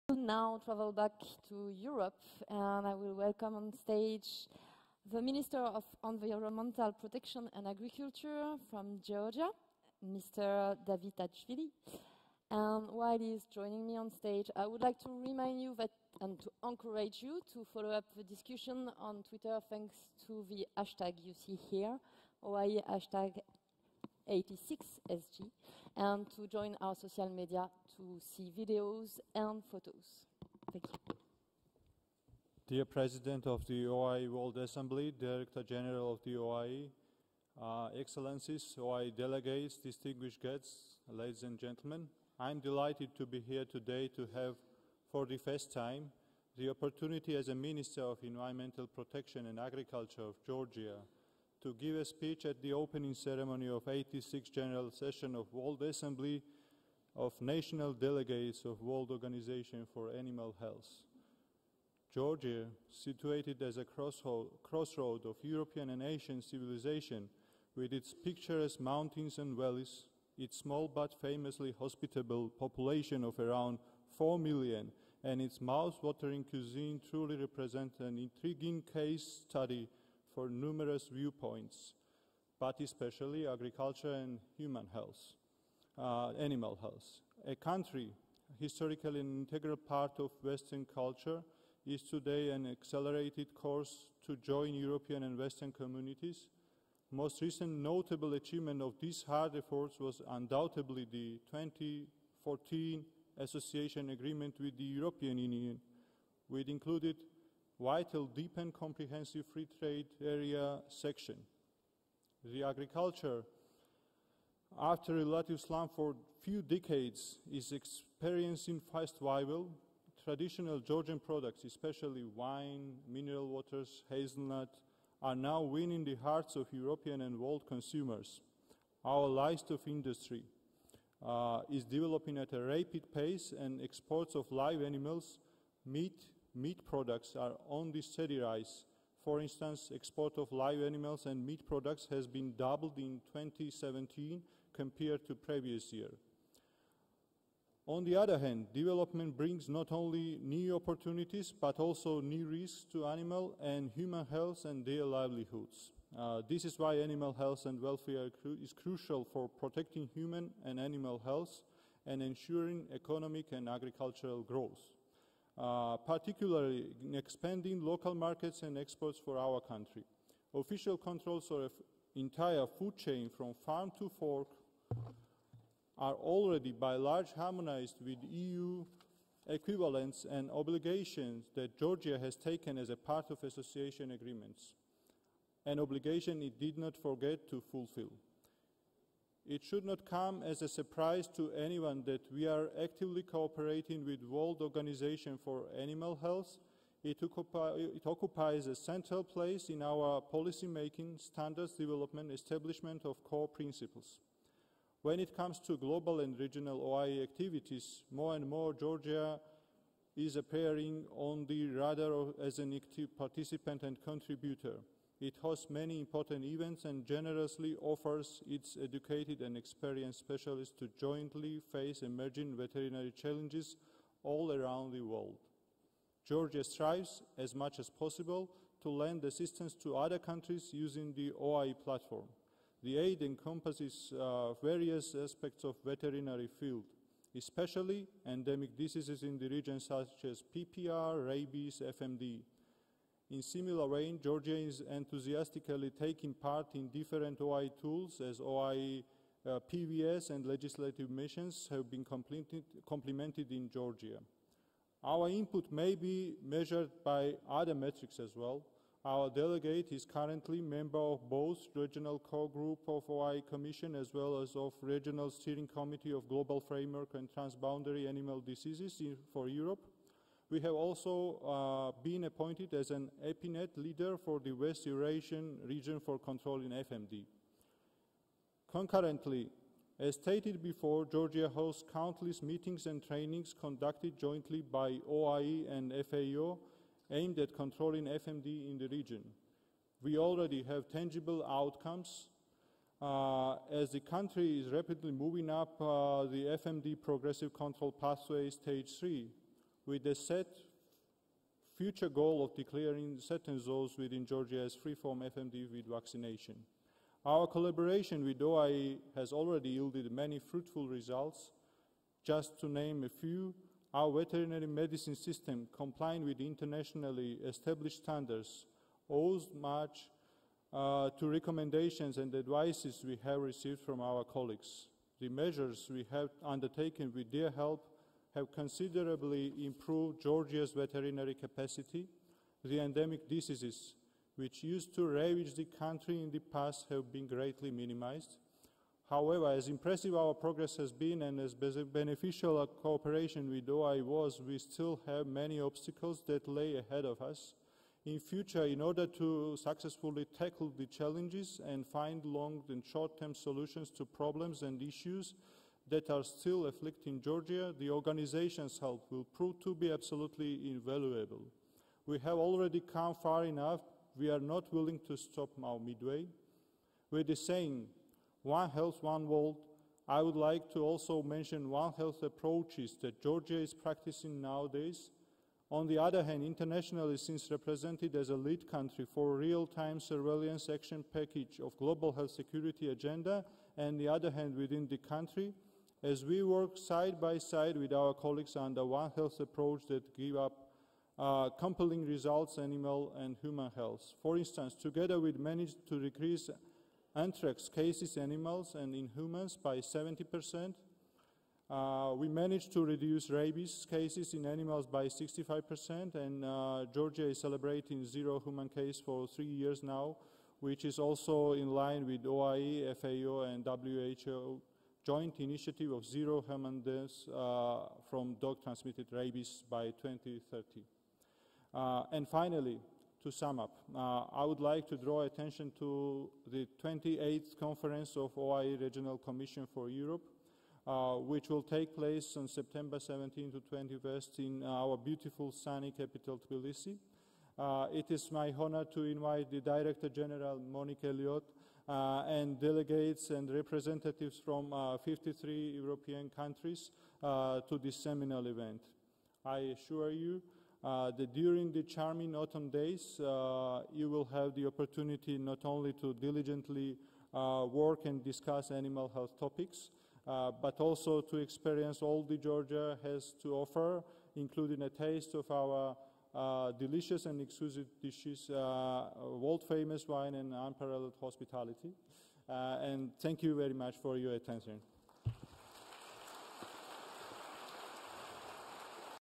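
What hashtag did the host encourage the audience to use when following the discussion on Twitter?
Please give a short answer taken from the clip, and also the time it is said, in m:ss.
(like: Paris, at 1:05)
OIE 86 SG, at 0:22.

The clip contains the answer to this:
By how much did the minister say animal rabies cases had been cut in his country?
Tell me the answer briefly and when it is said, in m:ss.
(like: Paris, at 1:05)
65%, at 6:45.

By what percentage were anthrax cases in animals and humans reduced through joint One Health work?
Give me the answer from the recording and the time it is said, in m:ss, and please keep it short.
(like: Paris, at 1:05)
70%, at 6:39.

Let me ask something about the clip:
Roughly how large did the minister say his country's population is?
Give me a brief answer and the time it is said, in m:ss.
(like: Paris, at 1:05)
around 4 million, at 1:13.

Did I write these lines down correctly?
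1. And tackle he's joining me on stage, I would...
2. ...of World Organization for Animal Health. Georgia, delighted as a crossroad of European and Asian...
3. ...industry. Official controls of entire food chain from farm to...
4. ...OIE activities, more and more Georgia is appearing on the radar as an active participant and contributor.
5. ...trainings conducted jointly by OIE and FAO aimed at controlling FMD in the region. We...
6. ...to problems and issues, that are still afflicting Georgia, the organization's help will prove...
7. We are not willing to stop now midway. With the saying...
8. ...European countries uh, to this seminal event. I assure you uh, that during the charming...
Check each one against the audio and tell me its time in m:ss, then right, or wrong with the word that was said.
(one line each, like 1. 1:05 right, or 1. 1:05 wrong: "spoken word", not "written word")
1. 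0:12 wrong: "while", not "tackle"
2. 0:58 wrong: "situated", not "delighted"
3. 2:49 wrong: "country", not "industry"
4. 3:26 right
5. 4:43 right
6. 5:53 right
7. 6:04 right
8. 7:25 right.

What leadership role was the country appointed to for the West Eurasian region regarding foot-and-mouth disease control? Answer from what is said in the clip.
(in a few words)
EPINET leader.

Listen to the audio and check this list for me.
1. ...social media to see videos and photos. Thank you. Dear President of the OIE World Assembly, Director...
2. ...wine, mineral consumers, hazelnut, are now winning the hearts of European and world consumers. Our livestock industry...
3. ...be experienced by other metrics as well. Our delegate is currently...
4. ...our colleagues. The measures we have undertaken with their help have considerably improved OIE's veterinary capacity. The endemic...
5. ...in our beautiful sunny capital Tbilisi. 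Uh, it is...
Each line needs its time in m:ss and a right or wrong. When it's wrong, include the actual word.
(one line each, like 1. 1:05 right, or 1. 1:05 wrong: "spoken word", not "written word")
1. 0:26 right
2. 2:02 wrong: "waters", not "consumers"
3. 4:15 wrong: "measured", not "experienced"
4. 5:24 wrong: "Georgia", not "OIE"
5. 7:14 right.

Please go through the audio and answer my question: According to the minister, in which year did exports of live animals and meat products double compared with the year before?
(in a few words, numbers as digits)
2017.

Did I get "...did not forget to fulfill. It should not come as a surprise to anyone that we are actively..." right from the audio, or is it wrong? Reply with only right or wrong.
right.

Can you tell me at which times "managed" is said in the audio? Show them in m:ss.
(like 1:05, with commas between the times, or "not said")
6:35, 6:42.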